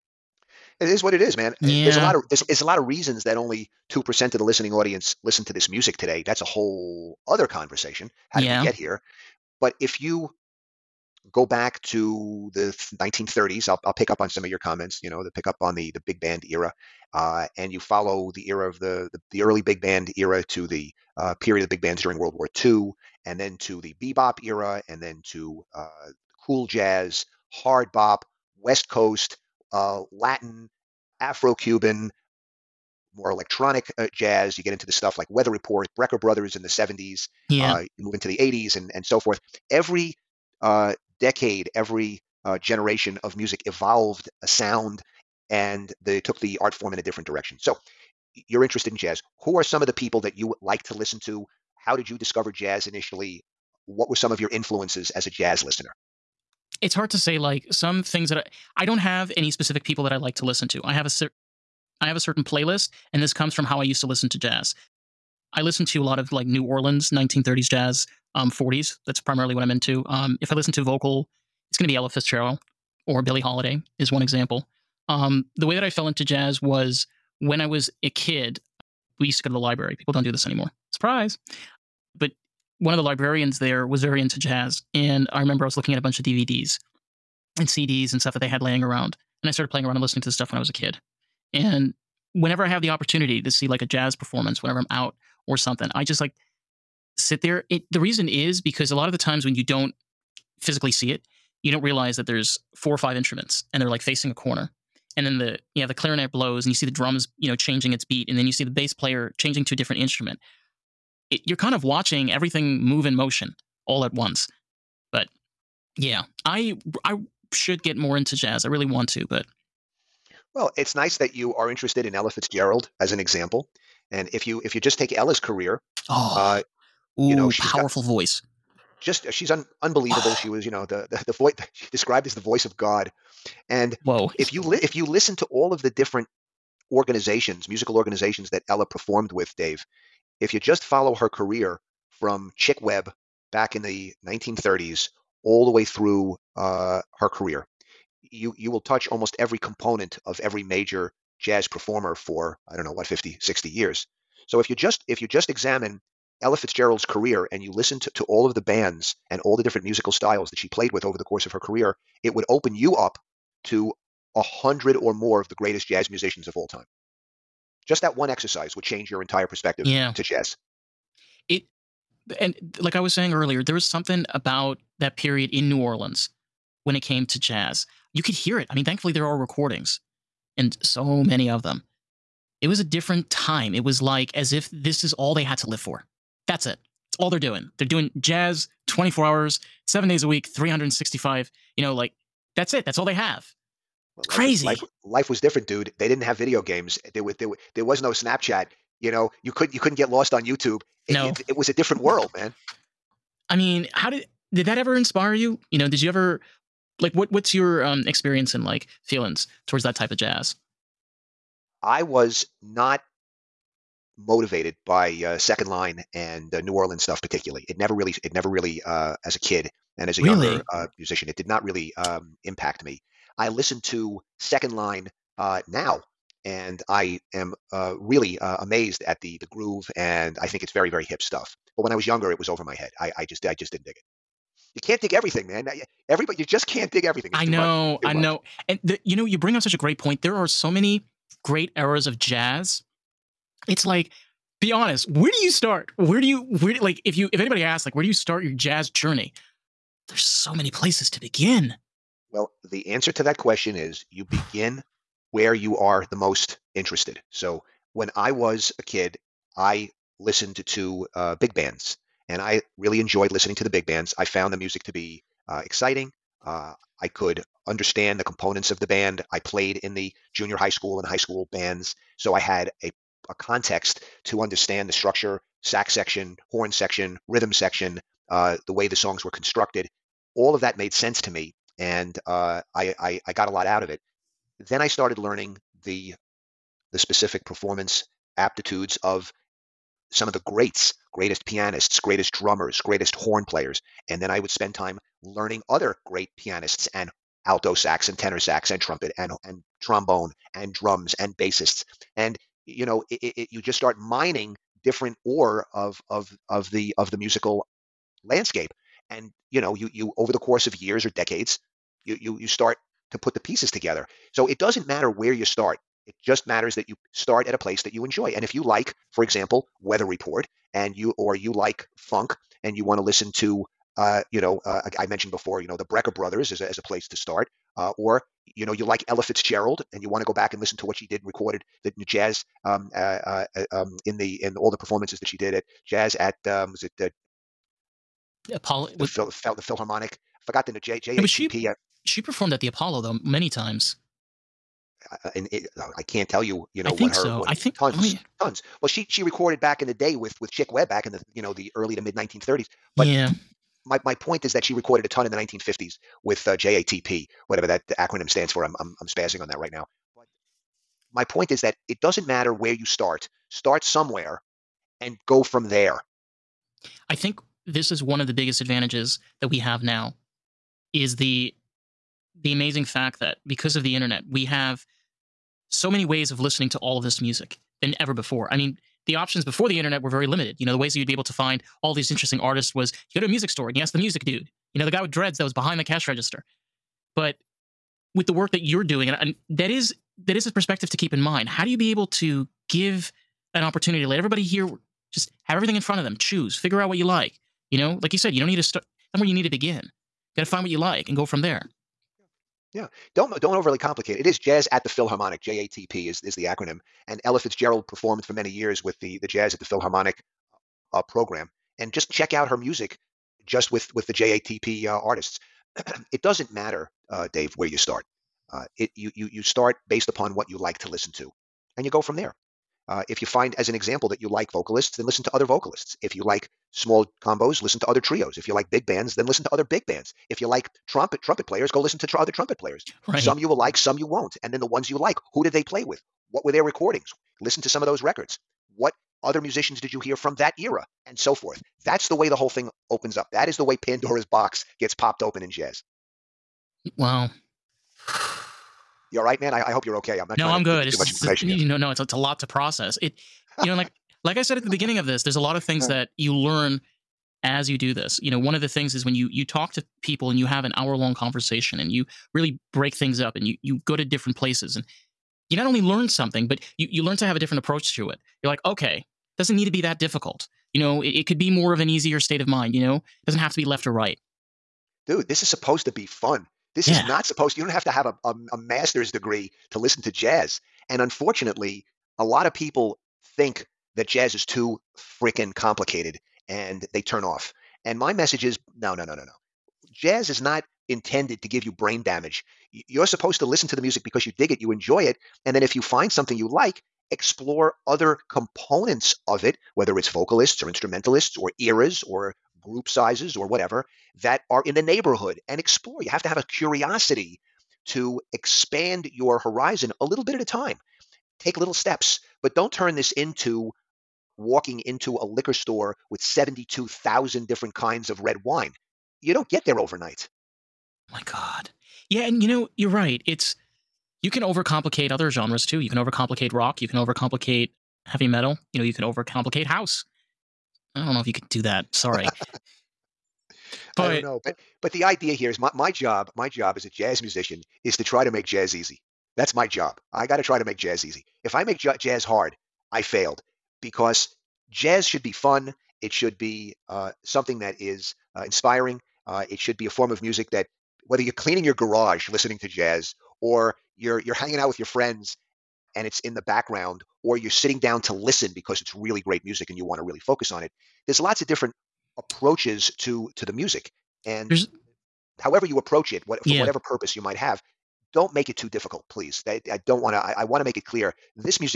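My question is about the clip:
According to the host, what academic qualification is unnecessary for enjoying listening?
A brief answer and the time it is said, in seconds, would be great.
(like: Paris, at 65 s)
Master's degree, at 478 s.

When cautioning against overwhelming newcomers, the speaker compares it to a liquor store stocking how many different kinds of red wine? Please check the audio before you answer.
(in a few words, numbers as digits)
72,000.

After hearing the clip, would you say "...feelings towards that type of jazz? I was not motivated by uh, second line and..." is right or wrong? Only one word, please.
right.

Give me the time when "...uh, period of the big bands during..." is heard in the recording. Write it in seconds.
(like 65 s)
21 s.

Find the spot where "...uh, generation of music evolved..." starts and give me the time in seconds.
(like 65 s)
42 s.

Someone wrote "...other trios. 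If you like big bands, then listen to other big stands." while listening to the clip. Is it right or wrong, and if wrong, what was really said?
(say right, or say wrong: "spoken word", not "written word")
wrong: "bands", not "stands".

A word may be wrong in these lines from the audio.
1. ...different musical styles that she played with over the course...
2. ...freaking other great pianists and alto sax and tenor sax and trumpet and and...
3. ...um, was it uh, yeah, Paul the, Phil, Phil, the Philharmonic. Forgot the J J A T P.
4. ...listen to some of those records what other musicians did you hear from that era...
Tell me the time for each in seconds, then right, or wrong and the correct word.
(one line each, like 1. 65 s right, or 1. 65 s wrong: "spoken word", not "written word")
1. 159 s right
2. 295 s wrong: "learning", not "freaking"
3. 336 s right
4. 437 s right.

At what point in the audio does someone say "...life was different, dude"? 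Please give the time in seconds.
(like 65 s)
195 s.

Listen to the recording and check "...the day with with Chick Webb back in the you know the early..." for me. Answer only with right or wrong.
right.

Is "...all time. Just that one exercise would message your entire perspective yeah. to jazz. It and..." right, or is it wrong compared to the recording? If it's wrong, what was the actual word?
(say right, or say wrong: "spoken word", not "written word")
wrong: "change", not "message".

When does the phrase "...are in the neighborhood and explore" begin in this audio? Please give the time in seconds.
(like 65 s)
504 s.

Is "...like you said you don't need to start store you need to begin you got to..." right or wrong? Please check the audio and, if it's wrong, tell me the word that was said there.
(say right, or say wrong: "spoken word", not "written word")
wrong: "somewhere", not "store".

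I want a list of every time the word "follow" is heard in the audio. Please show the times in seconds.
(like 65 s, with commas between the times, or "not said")
17 s, 140 s.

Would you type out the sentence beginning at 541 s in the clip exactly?
If I make j- jazz hard, I failed because jazz should be fun.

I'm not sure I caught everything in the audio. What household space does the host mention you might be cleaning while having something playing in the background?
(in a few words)
Garage.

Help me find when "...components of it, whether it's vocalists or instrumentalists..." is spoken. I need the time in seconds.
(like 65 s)
498 s.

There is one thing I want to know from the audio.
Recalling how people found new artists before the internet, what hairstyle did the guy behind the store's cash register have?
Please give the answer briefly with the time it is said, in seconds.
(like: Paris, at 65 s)
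Dreads, at 385 s.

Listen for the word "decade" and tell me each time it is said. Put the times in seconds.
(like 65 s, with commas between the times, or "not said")
41 s, 311 s.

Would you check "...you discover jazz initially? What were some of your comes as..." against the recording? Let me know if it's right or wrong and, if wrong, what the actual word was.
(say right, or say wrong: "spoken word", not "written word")
wrong: "influences", not "comes".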